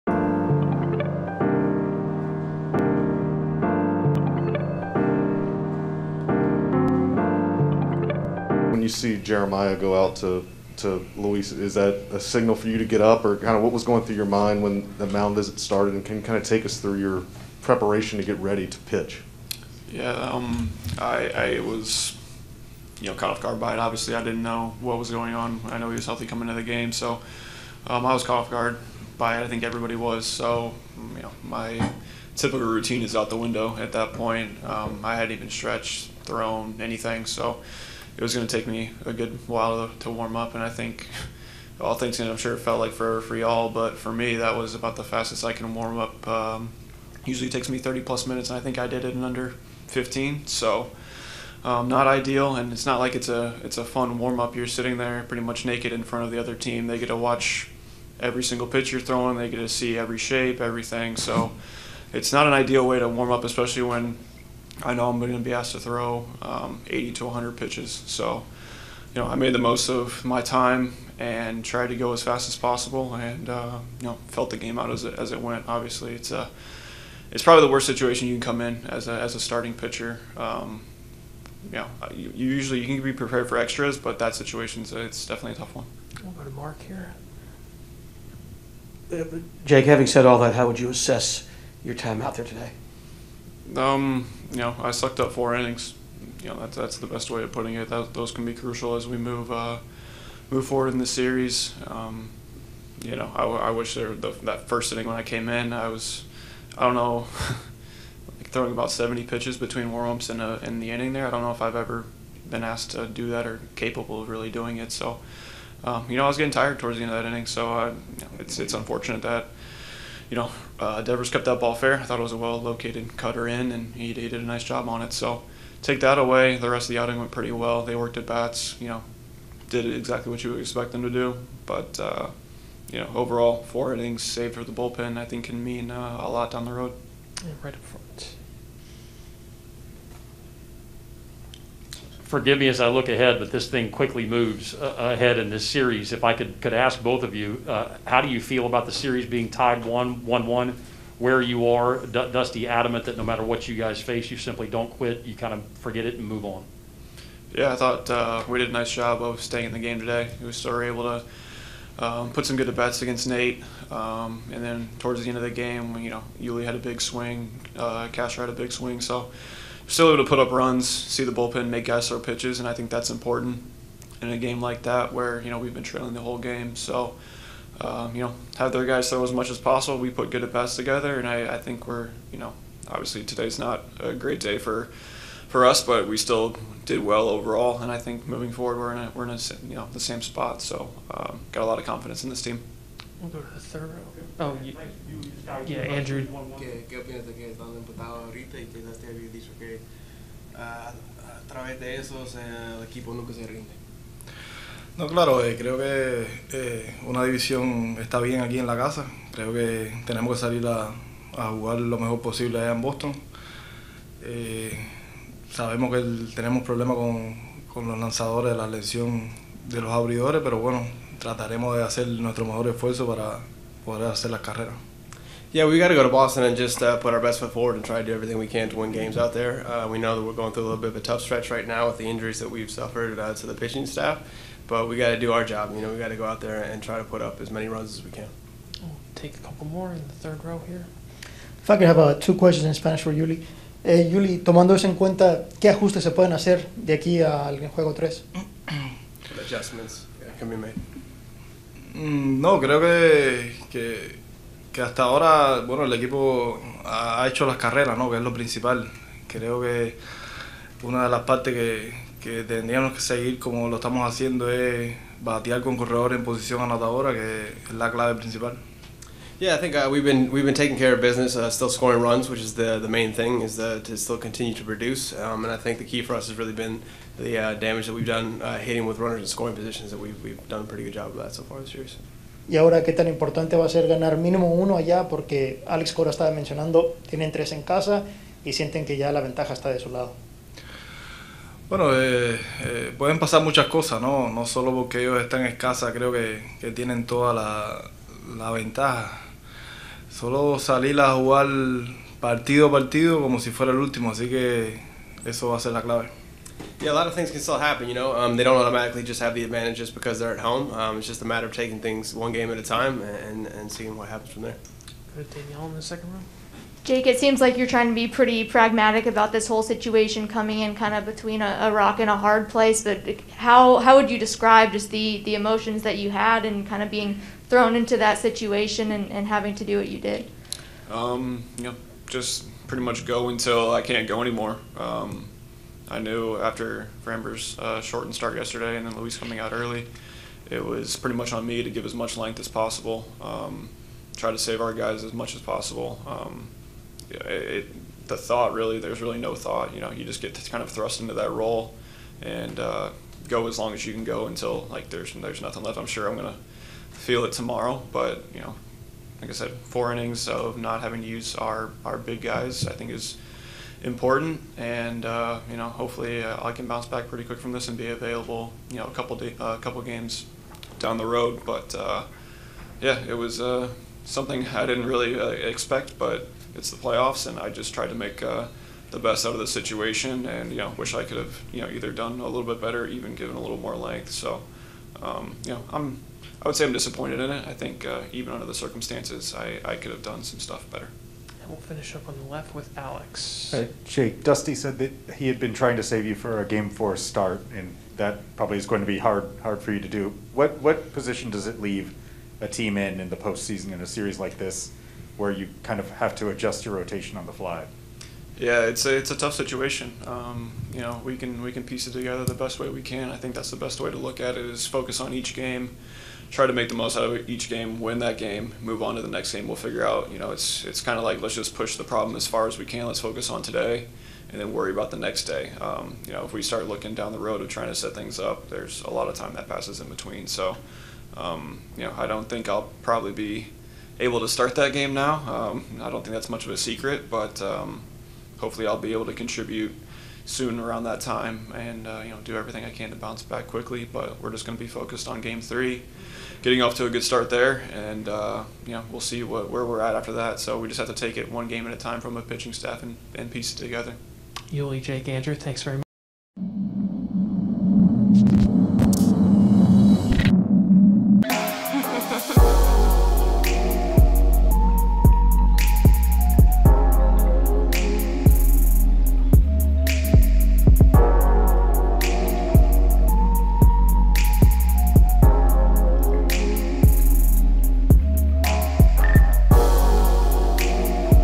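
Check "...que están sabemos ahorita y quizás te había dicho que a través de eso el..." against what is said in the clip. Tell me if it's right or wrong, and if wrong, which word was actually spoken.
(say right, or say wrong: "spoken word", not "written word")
wrong: "empatados", not "sabemos".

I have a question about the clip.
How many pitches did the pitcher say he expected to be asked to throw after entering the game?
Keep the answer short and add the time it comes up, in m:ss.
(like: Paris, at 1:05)
80 to 100, at 1:06.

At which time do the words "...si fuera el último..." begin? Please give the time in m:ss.
5:03.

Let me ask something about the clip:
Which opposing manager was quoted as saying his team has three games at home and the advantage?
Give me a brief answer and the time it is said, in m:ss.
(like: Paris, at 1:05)
Alex Cora, at 4:45.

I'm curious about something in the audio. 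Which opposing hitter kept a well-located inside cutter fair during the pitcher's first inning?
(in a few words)
Devers.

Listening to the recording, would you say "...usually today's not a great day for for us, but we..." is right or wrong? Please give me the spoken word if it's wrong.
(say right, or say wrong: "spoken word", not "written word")
wrong: "obviously", not "usually".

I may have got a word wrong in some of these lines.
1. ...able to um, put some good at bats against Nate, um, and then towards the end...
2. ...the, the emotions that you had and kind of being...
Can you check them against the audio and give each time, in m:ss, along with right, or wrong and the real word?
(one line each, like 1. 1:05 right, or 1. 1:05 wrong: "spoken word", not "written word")
1. 2:40 right
2. 5:24 right.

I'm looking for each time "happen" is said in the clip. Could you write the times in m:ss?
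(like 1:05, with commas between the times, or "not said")
5:07, 5:14.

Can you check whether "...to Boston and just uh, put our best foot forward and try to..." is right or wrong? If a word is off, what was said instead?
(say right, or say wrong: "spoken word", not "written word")
right.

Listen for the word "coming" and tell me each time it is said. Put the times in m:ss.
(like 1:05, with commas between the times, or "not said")
0:26, 5:20, 5:39.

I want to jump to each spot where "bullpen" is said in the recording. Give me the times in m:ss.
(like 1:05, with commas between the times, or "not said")
2:14, 2:51.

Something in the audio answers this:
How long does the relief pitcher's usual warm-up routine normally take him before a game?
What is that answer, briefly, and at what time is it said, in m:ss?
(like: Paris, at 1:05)
30 plus minutes, at 0:47.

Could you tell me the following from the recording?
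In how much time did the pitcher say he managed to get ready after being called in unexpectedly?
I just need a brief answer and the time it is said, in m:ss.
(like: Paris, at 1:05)
under 15, at 0:49.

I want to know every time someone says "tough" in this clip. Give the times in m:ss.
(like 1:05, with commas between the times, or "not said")
1:25, 3:51, 6:49.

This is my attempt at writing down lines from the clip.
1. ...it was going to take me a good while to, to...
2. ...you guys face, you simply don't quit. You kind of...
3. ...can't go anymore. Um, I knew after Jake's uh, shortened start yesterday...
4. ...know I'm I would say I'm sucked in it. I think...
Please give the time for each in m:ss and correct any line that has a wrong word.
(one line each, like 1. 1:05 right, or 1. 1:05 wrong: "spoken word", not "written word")
1. 0:38 right
2. 2:33 right
3. 5:33 wrong: "Framber", not "Jake"
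4. 6:25 wrong: "disappointed", not "sucked".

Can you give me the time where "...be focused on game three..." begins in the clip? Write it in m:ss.
7:24.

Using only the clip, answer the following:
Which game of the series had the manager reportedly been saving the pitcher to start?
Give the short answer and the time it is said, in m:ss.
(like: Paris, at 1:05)
game four, at 6:36.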